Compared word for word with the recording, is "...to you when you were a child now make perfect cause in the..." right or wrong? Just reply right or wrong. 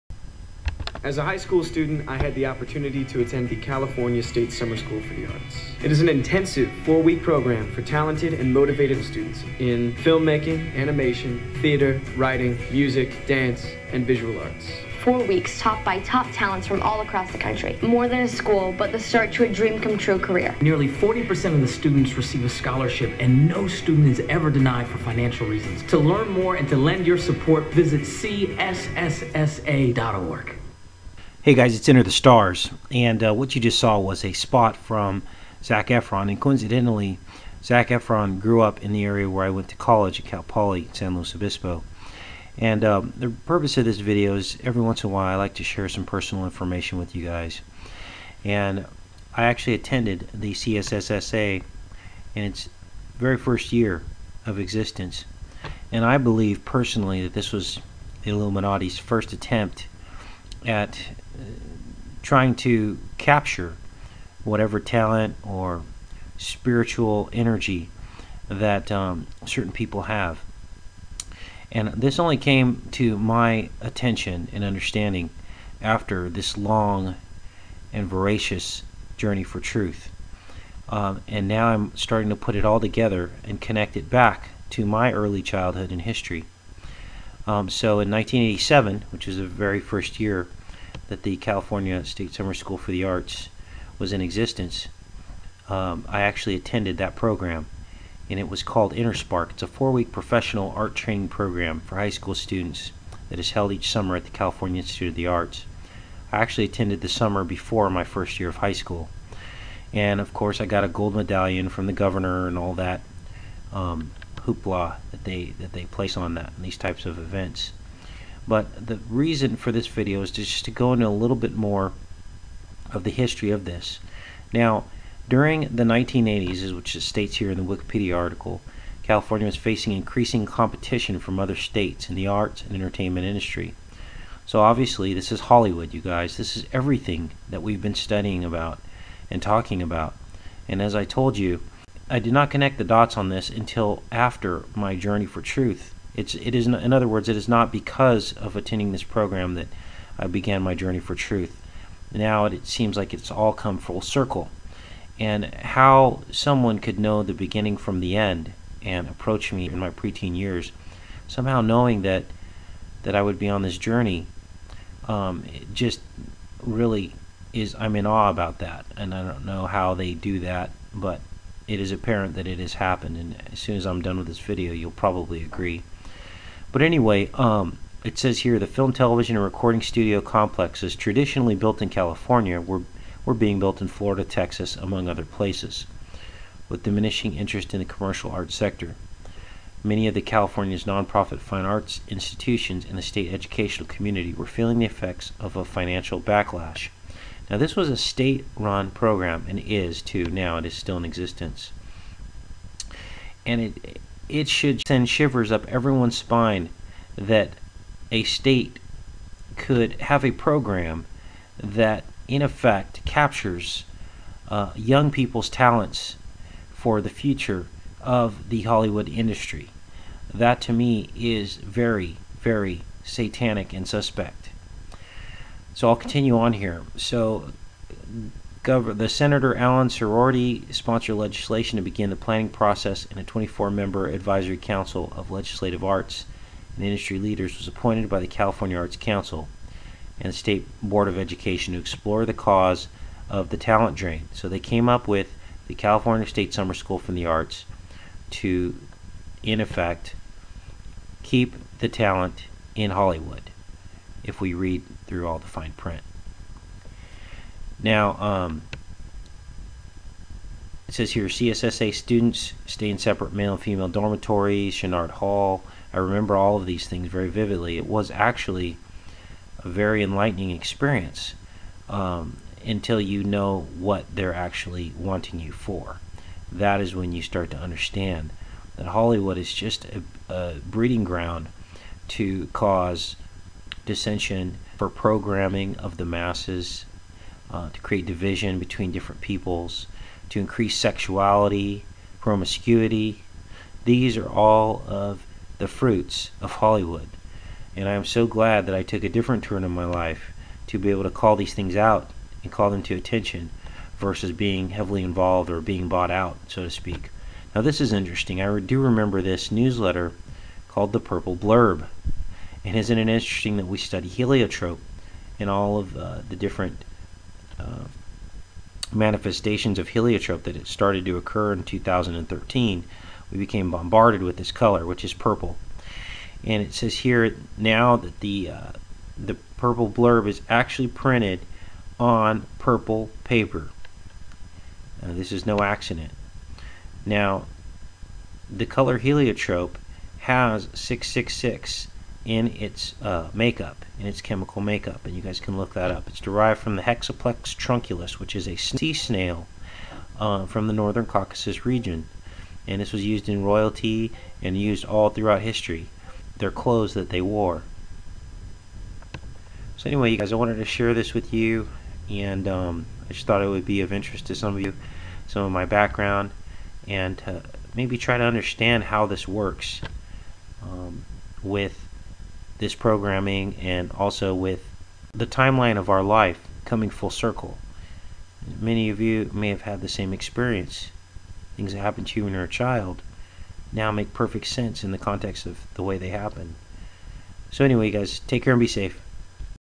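wrong.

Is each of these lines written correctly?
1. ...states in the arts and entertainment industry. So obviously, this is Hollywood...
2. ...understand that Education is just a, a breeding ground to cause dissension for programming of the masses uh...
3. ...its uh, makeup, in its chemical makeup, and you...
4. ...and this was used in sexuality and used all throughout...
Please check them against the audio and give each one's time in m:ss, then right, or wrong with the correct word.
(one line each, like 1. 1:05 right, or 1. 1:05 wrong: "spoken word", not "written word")
1. 2:11 right
2. 4:37 wrong: "Hollywood", not "Education"
3. 5:42 right
4. 5:52 wrong: "royalty", not "sexuality".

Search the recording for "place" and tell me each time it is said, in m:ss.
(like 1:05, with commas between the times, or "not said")
1:55, 3:05.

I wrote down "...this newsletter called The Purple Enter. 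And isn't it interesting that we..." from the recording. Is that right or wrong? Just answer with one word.
wrong.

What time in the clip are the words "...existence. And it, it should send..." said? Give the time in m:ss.
3:21.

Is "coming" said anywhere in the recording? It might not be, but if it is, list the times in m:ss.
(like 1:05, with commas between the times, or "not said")
6:16.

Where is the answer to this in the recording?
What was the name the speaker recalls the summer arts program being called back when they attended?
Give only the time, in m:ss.
1:38.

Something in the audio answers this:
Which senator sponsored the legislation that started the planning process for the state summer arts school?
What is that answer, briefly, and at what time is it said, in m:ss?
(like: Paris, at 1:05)
Alan Sieroty, at 3:49.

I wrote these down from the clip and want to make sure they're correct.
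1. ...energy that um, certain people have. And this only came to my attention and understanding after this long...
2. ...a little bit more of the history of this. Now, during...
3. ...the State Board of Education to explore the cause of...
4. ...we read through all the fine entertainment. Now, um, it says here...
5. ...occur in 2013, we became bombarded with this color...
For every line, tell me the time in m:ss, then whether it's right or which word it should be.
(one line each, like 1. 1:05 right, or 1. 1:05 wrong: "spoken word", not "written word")
1. 1:07 right
2. 2:01 right
3. 4:00 right
4. 4:14 wrong: "print", not "entertainment"
5. 5:21 right.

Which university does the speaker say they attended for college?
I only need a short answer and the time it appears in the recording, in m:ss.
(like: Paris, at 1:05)
Cal Poly, San Luis Obispo, at 0:40.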